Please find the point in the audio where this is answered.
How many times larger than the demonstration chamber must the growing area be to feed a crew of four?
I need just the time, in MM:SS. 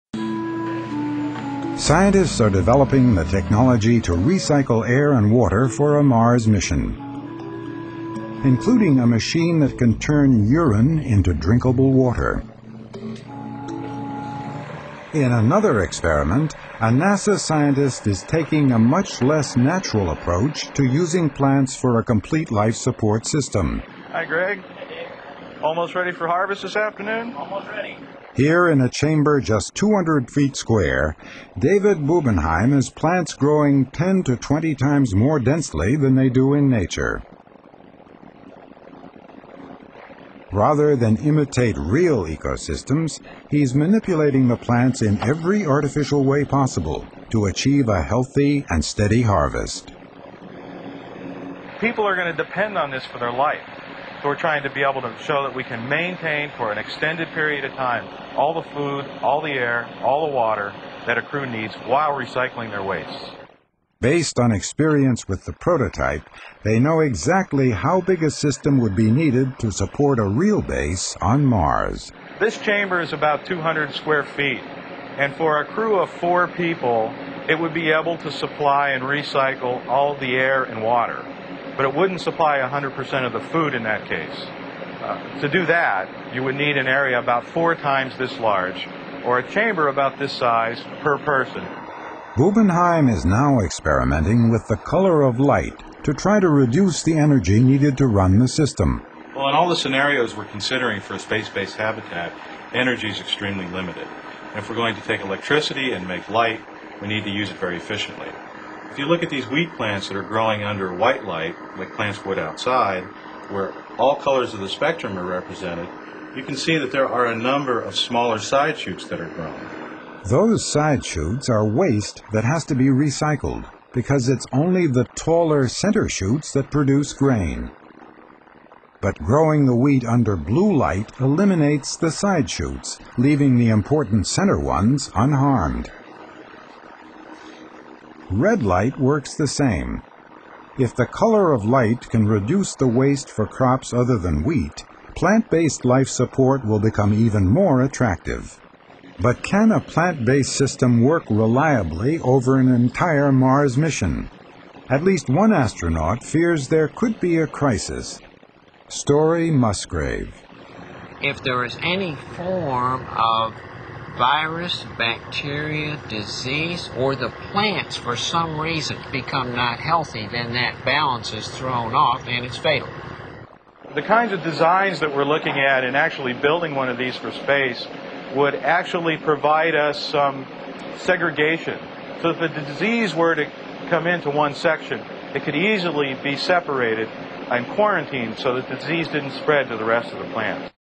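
01:27.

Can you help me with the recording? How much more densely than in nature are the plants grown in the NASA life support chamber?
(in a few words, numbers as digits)
10 to 20 times.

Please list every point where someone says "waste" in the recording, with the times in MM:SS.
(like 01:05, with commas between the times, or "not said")
01:02, 02:01, 02:22.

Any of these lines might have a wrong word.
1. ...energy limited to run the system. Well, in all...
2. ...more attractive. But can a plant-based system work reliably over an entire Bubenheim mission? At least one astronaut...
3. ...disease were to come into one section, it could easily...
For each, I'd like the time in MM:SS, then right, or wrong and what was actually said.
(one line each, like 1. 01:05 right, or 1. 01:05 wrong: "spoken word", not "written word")
1. 01:37 wrong: "needed", not "limited"
2. 02:27 wrong: "Mars", not "Bubenheim"
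3. 03:02 right.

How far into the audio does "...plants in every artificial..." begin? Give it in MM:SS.
00:44.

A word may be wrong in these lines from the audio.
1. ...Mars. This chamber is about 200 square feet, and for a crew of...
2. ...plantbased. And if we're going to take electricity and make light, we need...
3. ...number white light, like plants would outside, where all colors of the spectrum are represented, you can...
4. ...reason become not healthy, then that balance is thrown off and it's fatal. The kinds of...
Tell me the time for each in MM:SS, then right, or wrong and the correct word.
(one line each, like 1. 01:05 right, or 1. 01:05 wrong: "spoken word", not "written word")
1. 01:11 right
2. 01:43 wrong: "limited", not "plantbased"
3. 01:50 wrong: "under", not "number"
4. 02:48 right.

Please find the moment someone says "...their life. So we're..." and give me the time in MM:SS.
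00:53.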